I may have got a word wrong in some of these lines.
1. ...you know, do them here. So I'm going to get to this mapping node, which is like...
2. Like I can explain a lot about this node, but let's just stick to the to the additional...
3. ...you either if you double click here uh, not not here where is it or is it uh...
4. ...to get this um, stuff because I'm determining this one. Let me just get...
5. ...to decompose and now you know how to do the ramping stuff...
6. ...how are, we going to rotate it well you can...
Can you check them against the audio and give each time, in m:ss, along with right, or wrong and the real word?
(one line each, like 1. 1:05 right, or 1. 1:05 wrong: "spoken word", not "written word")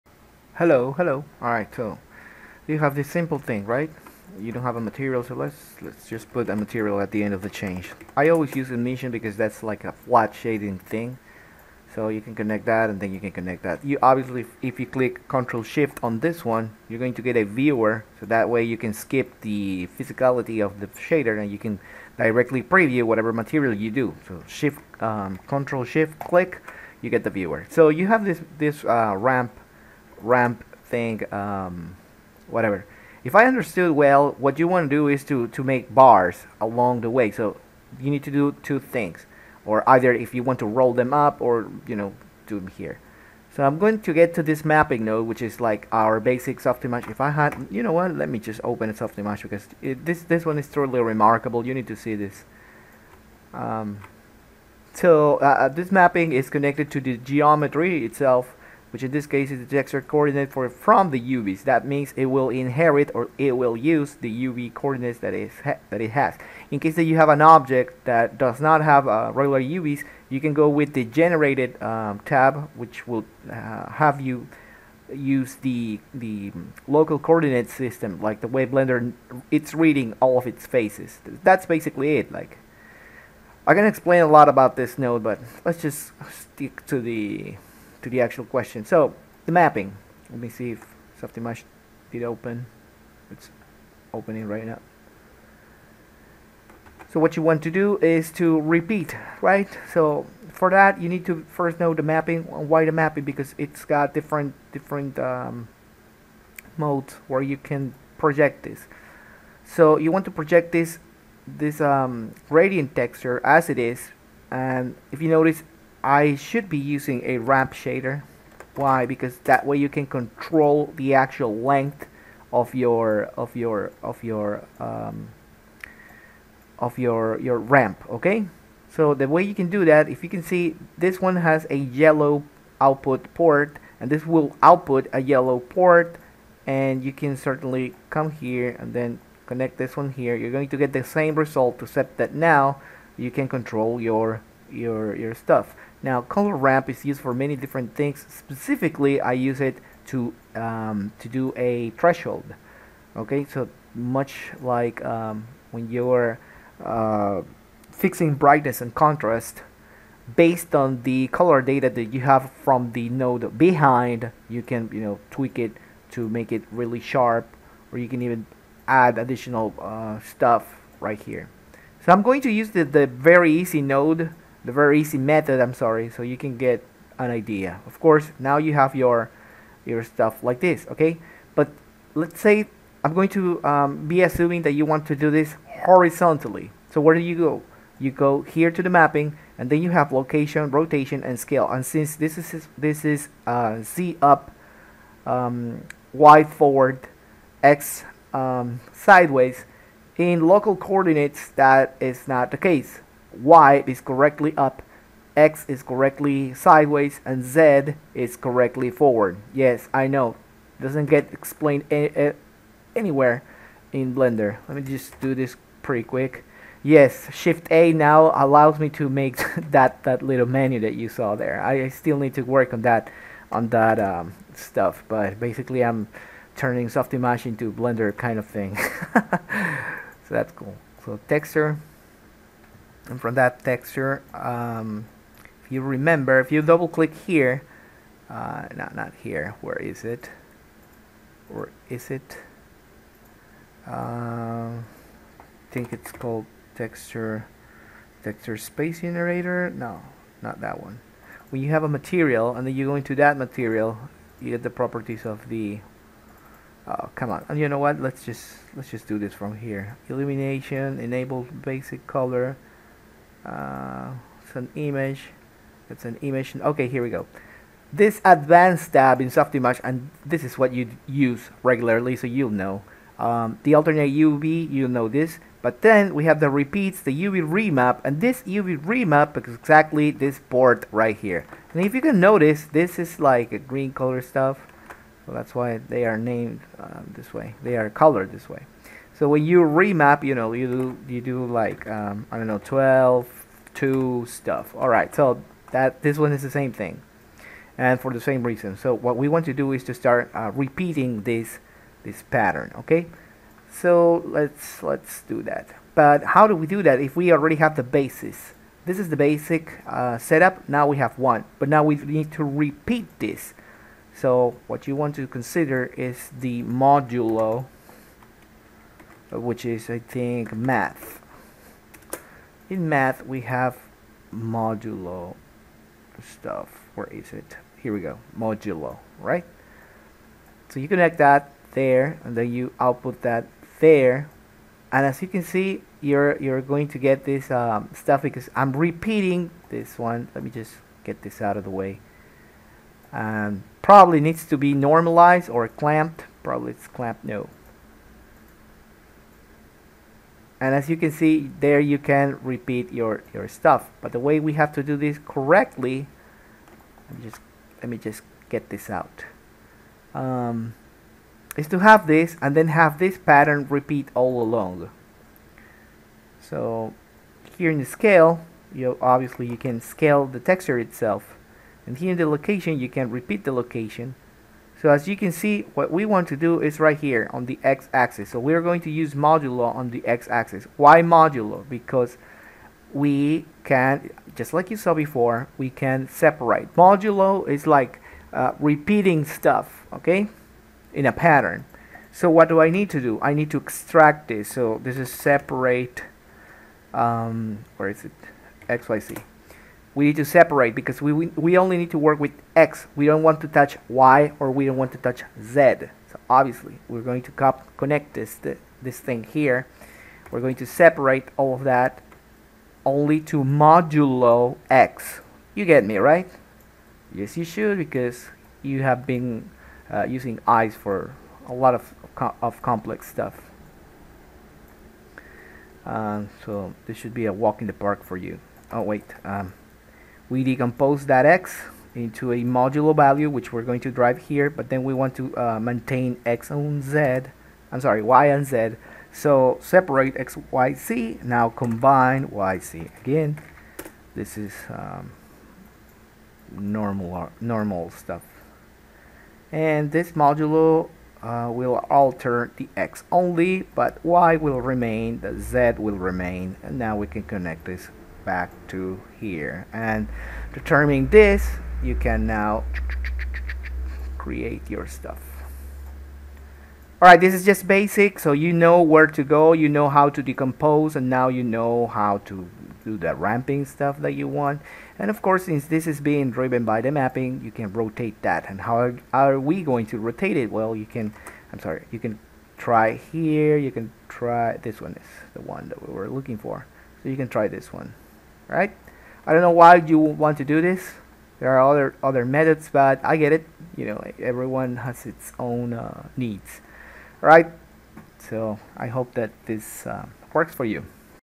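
1. 0:41 right
2. 1:22 wrong: "actual", not "additional"
3. 3:55 wrong: "remember", not "either"
4. 5:36 wrong: "repeating", not "determining"
5. 7:50 right
6. 7:58 right.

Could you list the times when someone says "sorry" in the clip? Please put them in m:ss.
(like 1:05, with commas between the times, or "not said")
2:55, 7:17, 8:01.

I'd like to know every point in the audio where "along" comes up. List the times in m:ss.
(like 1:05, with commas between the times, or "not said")
0:36, 6:04.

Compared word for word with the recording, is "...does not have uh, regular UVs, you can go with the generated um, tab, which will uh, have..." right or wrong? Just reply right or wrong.
right.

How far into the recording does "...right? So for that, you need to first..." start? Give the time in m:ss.
1:39.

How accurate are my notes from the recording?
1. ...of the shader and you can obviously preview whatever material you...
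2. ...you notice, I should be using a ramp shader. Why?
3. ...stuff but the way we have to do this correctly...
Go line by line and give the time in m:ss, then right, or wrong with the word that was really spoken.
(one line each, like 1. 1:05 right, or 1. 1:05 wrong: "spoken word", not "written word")
1. 0:20 wrong: "directly", not "obviously"
2. 1:55 right
3. 5:53 right.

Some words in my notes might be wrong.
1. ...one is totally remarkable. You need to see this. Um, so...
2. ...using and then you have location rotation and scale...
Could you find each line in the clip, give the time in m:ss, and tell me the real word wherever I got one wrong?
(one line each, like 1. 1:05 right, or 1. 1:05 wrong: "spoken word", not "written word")
1. 0:50 right
2. 3:08 wrong: "mapping", not "using".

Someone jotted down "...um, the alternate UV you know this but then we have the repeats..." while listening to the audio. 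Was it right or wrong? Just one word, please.
right.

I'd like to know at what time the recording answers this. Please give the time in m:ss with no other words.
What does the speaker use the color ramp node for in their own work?
2:31.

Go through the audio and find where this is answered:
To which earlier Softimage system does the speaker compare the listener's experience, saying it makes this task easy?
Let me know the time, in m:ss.
7:00.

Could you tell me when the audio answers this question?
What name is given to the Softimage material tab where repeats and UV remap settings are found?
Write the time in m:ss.
4:28.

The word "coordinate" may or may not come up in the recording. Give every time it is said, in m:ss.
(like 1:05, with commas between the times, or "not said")
1:00, 1:04, 1:17, 3:20.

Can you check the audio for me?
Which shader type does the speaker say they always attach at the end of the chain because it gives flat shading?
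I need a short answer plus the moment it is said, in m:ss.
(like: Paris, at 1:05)
Emission, at 0:08.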